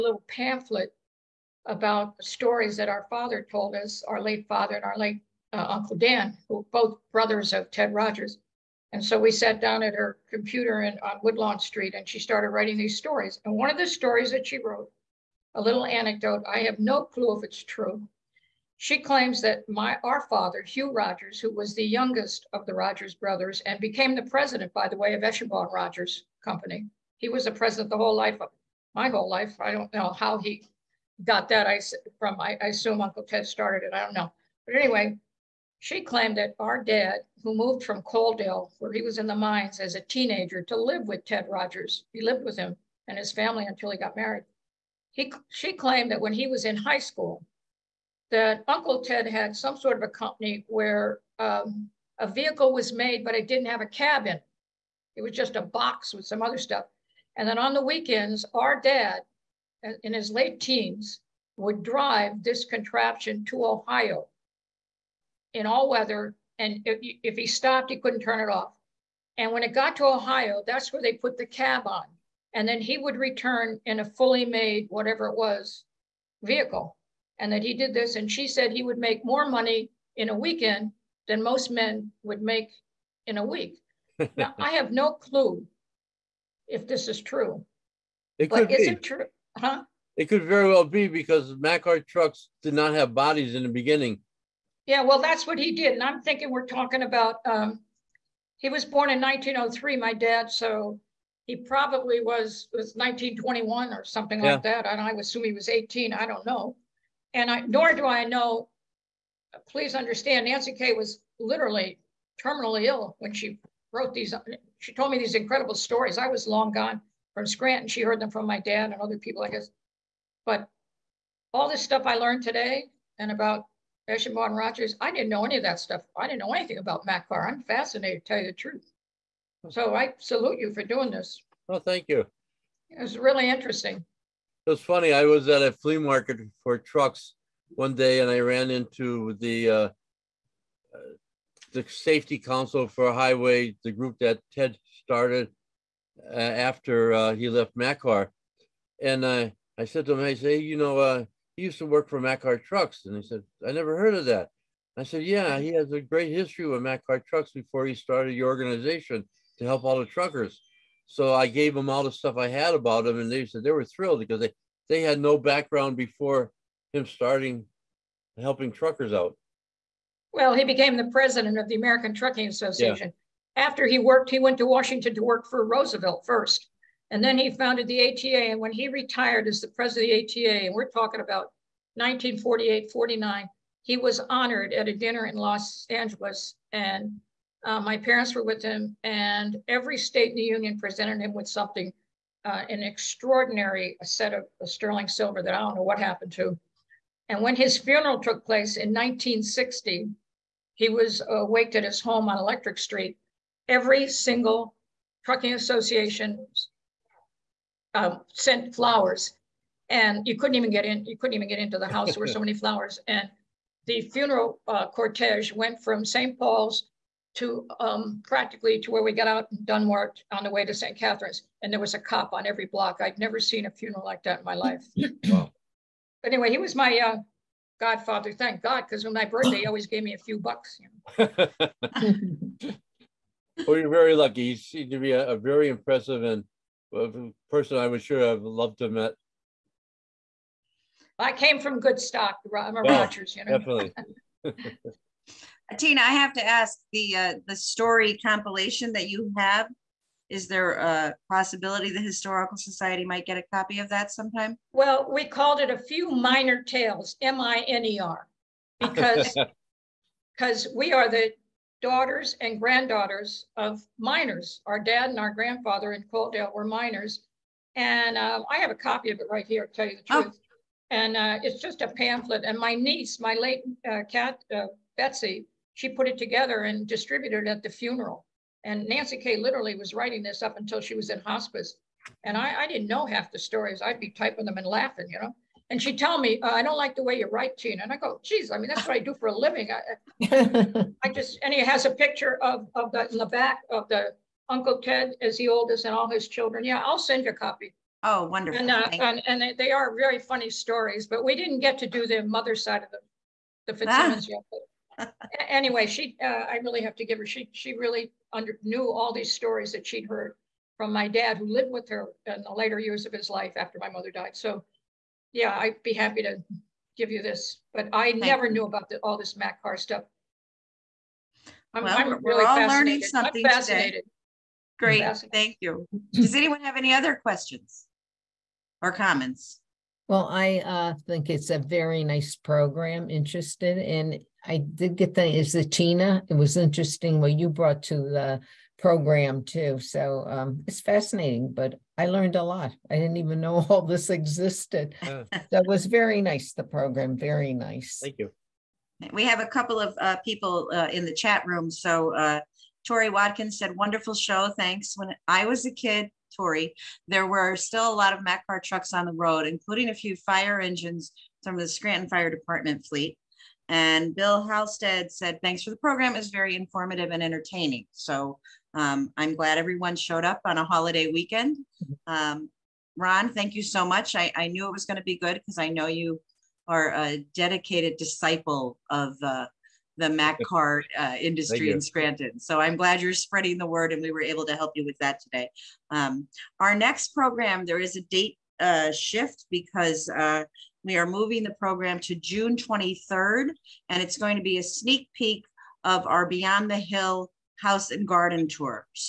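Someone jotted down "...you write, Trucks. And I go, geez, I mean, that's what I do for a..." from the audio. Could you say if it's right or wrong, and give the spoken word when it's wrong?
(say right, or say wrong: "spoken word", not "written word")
wrong: "Tina", not "Trucks".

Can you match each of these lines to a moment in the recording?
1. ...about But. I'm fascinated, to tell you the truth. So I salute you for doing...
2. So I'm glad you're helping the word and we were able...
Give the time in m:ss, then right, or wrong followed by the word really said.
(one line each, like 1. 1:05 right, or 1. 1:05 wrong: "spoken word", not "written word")
1. 2:06 wrong: "Macar", not "But"
2. 6:22 wrong: "spreading", not "helping".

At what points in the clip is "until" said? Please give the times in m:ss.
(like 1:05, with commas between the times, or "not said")
0:43, 4:40.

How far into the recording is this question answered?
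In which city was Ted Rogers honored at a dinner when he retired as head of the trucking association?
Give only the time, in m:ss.
3:05.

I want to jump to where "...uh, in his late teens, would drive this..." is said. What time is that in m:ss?
0:59.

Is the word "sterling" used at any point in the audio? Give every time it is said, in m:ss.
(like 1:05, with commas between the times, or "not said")
3:14.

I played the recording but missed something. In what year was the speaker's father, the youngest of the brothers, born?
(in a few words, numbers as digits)
1903.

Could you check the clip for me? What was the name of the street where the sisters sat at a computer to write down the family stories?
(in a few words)
Woodlawn Street.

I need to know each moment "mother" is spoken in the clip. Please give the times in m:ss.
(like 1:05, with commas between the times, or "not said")
5:02, 5:13.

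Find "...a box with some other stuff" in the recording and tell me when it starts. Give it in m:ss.
0:55.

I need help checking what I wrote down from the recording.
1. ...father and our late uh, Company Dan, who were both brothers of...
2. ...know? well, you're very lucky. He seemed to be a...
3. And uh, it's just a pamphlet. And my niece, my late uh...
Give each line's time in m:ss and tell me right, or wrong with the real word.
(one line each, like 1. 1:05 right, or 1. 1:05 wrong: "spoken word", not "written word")
1. 0:04 wrong: "Uncle", not "Company"
2. 3:51 right
3. 4:30 right.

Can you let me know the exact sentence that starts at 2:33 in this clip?
And he said, I never heard of that.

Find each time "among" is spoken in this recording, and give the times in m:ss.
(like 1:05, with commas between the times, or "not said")
not said.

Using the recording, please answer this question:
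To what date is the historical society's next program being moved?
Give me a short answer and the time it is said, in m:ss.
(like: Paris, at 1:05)
June 23, at 6:32.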